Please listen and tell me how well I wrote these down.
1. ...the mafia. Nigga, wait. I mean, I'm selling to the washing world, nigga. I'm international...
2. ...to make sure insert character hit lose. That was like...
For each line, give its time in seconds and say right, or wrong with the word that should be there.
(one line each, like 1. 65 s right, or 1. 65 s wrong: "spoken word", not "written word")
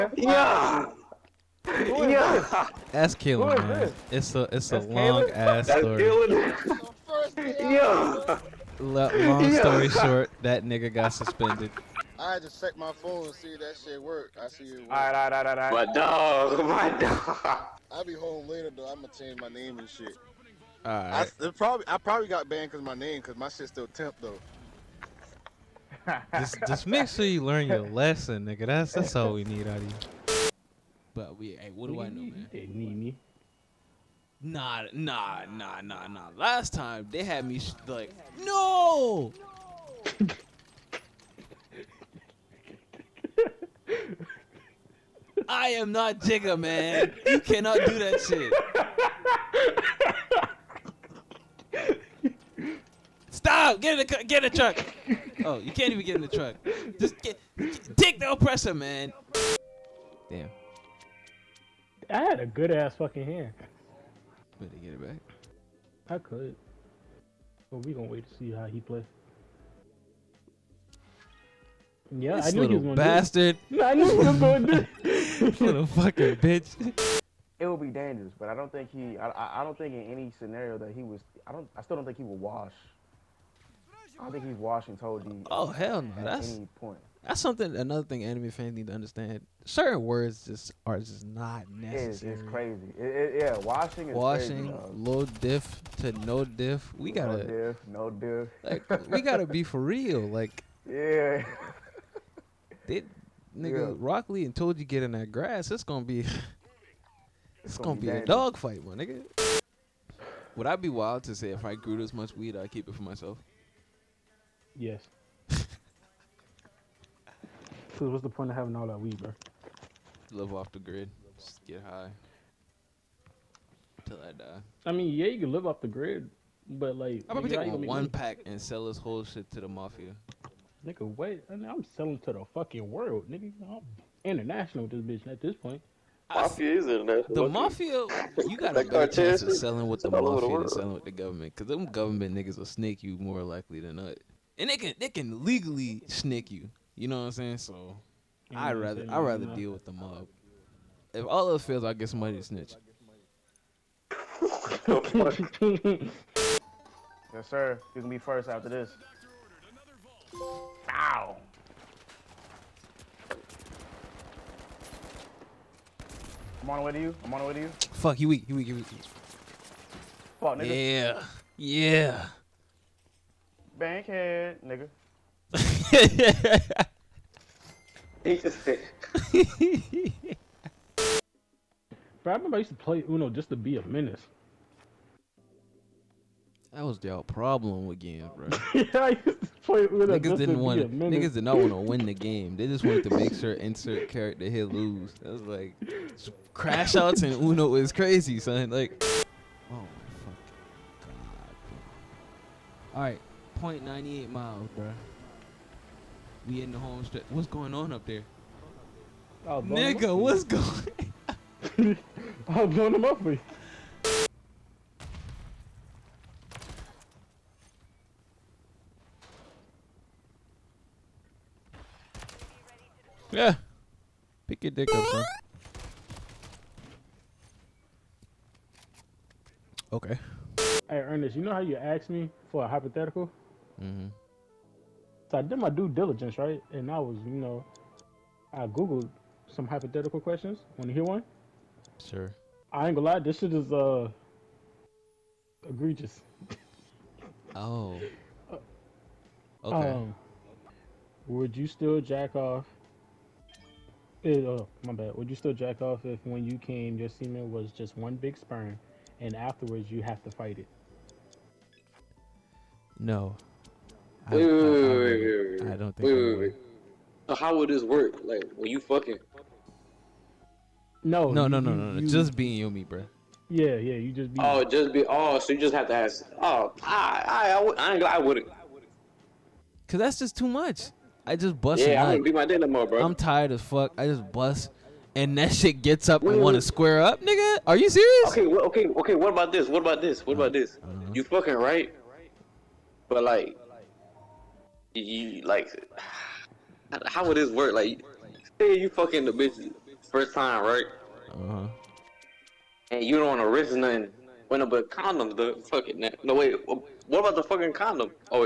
1. 129 s wrong: "fucking", not "washing"
2. 193 s right.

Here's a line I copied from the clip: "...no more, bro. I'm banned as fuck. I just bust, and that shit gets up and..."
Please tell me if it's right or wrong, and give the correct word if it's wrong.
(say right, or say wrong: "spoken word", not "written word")
wrong: "tired", not "banned".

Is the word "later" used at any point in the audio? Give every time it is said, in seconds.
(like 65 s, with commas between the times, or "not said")
18 s.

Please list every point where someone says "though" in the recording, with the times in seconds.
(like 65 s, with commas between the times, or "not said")
18 s, 24 s.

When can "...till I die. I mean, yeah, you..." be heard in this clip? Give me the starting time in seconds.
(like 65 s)
124 s.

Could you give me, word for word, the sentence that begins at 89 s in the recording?
Certain words just are just not necessary.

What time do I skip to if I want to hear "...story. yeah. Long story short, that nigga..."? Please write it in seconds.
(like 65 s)
5 s.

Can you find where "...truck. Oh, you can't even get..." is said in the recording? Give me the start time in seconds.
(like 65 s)
54 s.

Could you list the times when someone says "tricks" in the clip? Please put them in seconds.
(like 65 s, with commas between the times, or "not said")
not said.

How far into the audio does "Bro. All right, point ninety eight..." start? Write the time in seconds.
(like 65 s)
201 s.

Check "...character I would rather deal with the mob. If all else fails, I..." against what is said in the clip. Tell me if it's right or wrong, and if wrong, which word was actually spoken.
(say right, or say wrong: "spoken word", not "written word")
wrong: "rather", not "character".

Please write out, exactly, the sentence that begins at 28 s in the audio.
That's that's all we need out of you.